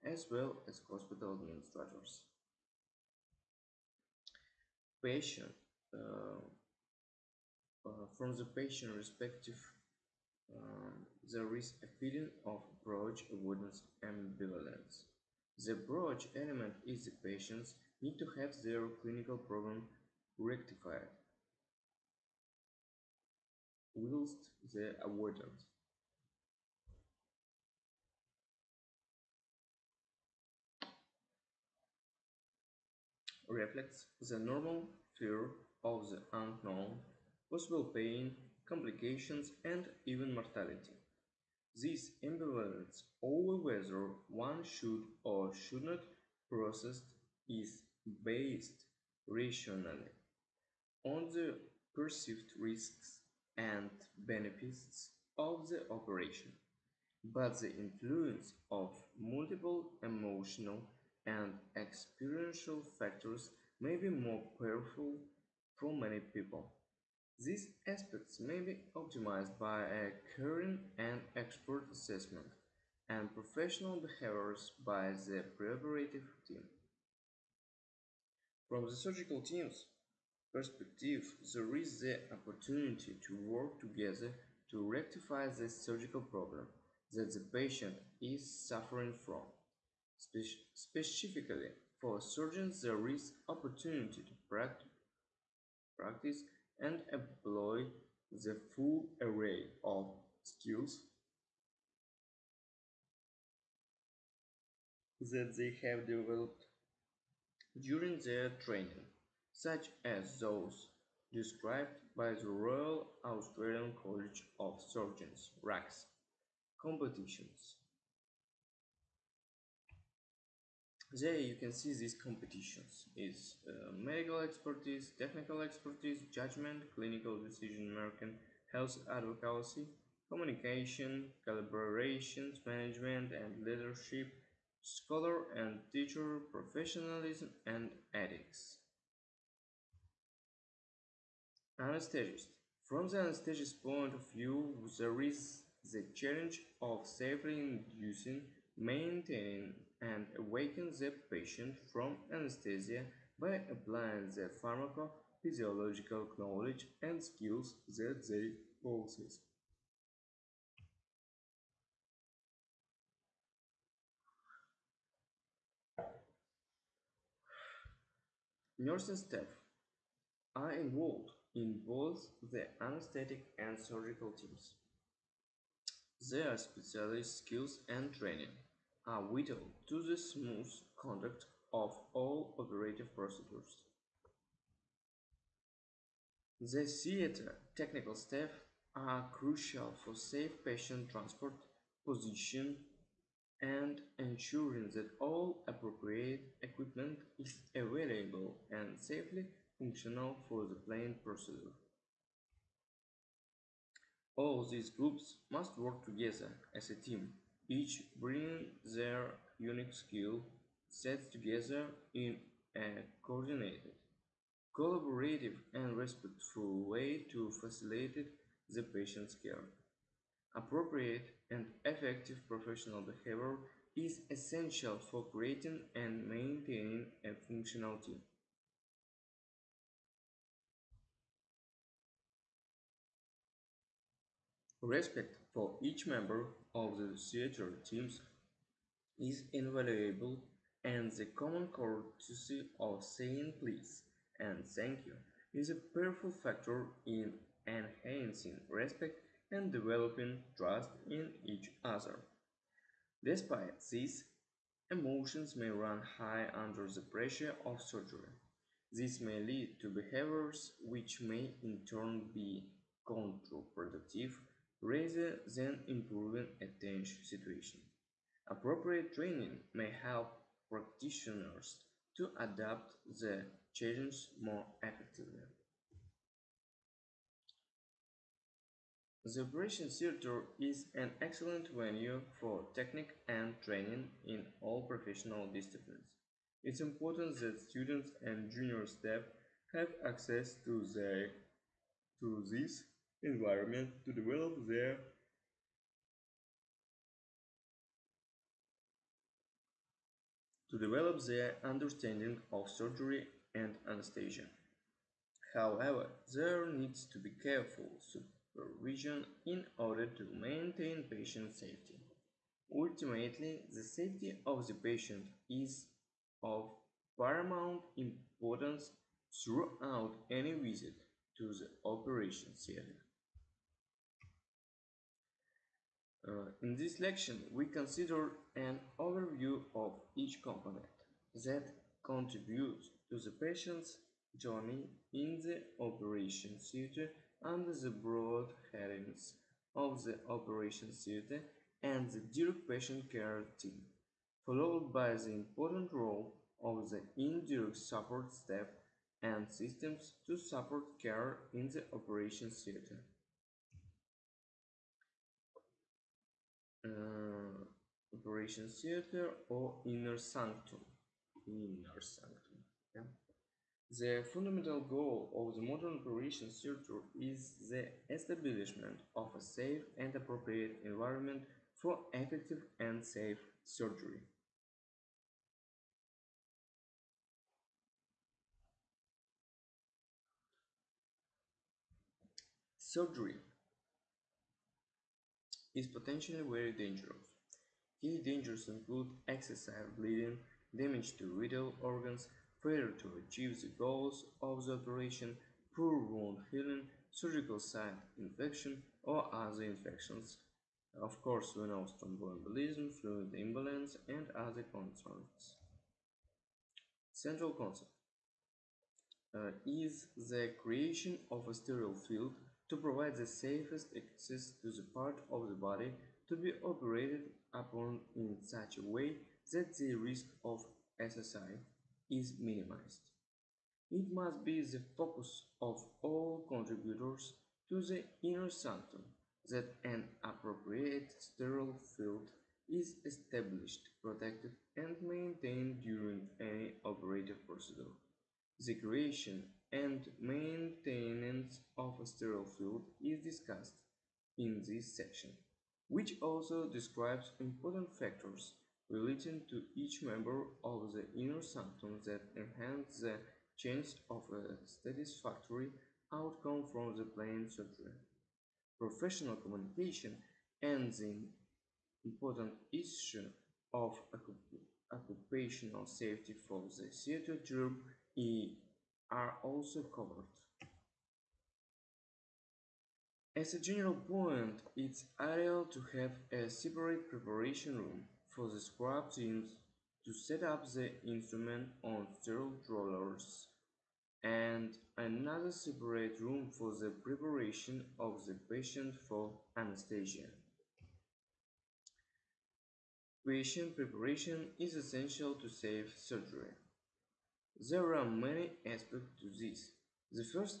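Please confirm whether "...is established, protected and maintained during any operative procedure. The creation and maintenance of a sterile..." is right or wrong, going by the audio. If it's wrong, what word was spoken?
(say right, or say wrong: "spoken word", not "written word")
right.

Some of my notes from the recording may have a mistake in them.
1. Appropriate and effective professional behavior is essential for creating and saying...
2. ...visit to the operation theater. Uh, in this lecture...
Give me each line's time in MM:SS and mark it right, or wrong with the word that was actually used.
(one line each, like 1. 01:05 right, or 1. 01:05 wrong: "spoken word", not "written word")
1. 03:40 wrong: "maintaining", not "saying"
2. 05:20 right.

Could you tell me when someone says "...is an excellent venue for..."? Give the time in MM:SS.
04:40.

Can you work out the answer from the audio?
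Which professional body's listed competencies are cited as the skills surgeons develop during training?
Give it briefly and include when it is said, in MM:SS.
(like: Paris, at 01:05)
Royal Australian College of Surgeons, at 01:52.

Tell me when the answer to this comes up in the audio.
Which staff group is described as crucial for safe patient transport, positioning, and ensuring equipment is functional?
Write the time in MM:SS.
03:06.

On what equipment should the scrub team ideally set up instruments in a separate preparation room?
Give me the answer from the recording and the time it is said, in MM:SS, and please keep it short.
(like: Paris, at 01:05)
Sterile rollers, at 08:02.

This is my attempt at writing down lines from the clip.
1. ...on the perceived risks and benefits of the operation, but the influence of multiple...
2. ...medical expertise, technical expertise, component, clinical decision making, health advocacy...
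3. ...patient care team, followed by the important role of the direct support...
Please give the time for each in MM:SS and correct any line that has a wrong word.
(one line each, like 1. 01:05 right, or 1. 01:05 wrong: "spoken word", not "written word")
1. 00:51 right
2. 02:03 wrong: "judgment", not "component"
3. 05:42 wrong: "indirect", not "direct".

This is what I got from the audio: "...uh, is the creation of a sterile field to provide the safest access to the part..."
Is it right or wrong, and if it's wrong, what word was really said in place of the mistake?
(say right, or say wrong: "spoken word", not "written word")
right.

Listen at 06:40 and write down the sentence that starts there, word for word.
Of course, we know thromboembolism, fluid imbalance, and other concerns.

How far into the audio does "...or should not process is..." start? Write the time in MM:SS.
00:45.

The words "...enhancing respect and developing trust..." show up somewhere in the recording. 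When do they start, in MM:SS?
04:07.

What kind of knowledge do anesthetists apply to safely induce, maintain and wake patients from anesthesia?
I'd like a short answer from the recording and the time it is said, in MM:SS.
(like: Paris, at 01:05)
Pharmacophysiological knowledge, at 02:34.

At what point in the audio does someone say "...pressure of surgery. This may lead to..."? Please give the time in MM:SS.
04:17.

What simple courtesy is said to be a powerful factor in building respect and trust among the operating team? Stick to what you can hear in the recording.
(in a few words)
Saying please and thank you.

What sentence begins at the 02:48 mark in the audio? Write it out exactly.
Nursing staff are involved in both the anesthetic and surgical teams.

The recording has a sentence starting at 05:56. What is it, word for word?
uh, Operation Theater or Inner Sanctum.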